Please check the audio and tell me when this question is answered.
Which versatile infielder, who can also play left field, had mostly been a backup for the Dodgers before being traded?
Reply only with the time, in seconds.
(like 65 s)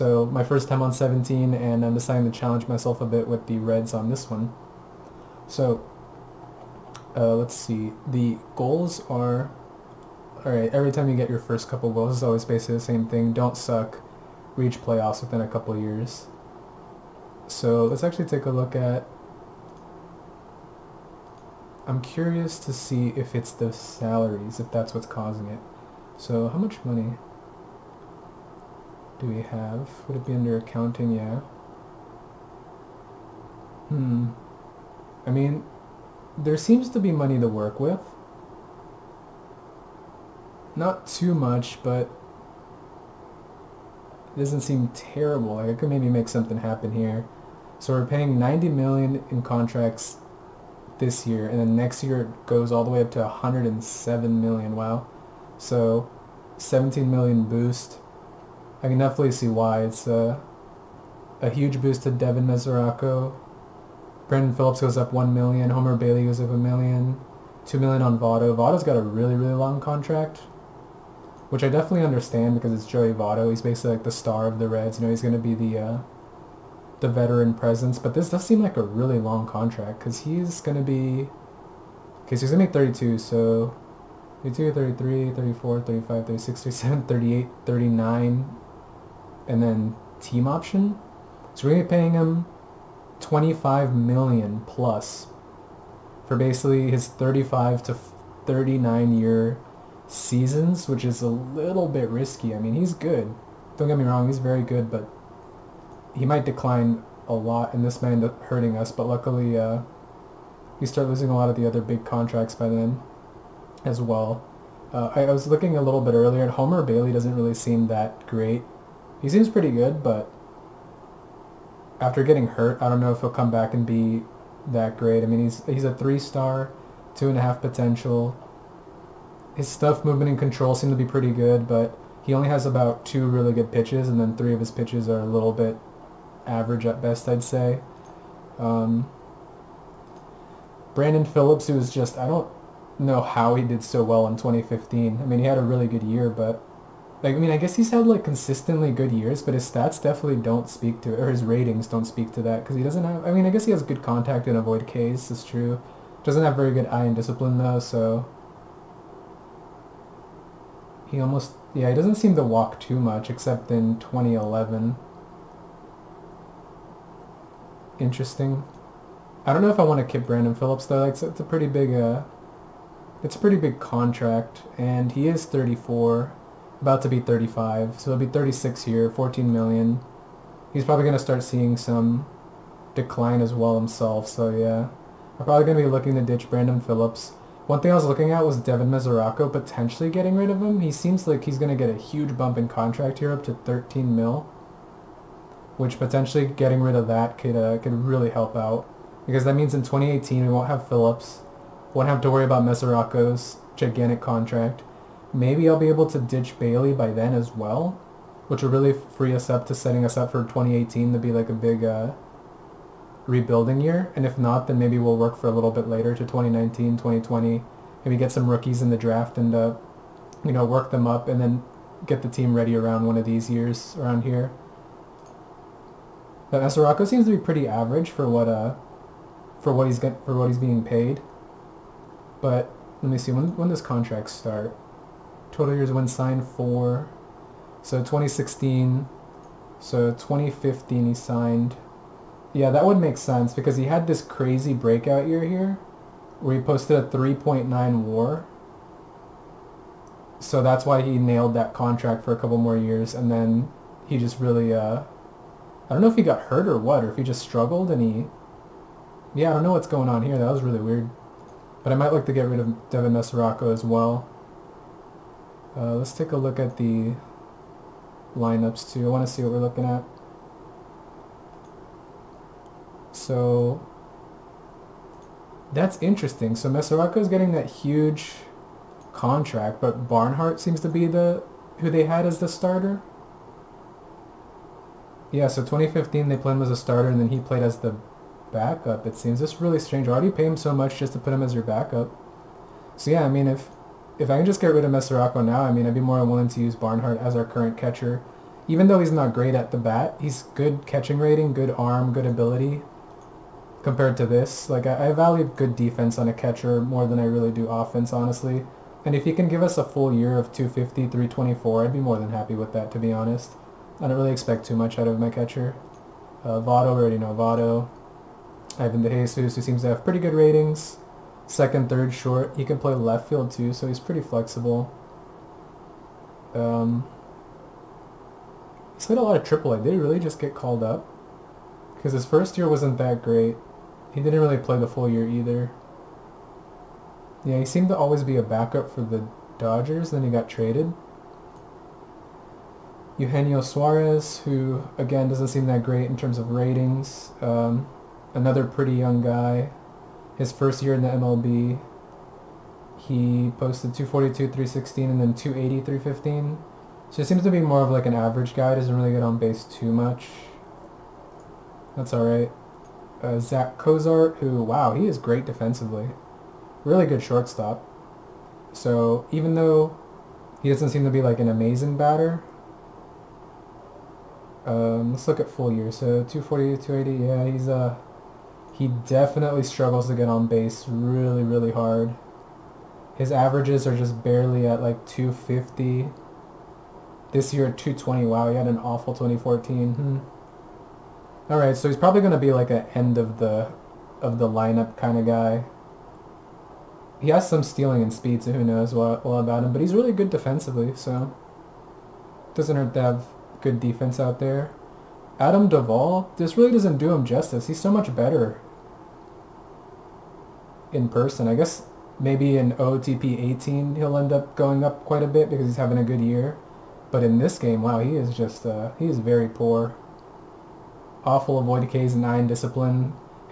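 318 s.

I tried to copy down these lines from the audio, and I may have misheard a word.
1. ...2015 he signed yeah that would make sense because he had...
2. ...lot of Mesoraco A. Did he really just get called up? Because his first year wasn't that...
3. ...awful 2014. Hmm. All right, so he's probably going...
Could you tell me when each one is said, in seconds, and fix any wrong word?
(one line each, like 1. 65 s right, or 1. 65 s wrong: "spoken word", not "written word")
1. 240 s right
2. 329 s wrong: "Triple", not "Mesoraco"
3. 388 s right.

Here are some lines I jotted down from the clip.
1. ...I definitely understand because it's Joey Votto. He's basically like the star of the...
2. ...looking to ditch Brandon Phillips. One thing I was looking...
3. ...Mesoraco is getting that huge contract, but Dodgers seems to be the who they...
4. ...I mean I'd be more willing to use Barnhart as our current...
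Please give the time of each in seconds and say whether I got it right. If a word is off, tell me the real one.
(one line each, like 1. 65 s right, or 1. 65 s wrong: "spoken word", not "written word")
1. 71 s right
2. 185 s right
3. 276 s wrong: "Barnhart", not "Dodgers"
4. 295 s right.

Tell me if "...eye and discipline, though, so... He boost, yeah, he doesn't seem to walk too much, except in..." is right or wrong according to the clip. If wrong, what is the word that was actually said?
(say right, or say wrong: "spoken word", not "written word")
wrong: "almost", not "boost".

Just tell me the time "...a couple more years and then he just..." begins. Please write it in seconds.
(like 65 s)
252 s.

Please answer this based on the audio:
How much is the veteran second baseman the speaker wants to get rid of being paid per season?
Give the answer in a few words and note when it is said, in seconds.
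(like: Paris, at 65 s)
14 million, at 179 s.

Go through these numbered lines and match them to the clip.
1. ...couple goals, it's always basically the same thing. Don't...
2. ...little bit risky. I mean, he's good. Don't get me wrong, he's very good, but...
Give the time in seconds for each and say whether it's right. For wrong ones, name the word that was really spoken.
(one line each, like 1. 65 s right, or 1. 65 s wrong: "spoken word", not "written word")
1. 11 s right
2. 101 s right.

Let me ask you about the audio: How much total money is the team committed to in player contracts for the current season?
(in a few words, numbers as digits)
90 million.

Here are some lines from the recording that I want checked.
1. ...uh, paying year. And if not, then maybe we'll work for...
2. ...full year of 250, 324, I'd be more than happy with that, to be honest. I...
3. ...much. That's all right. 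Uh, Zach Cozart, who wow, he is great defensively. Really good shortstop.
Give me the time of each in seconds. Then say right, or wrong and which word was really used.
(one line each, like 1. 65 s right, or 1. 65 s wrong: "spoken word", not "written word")
1. 211 s wrong: "rebuilding", not "paying"
2. 309 s right
3. 359 s right.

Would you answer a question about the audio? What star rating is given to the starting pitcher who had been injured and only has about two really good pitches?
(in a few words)
three-star.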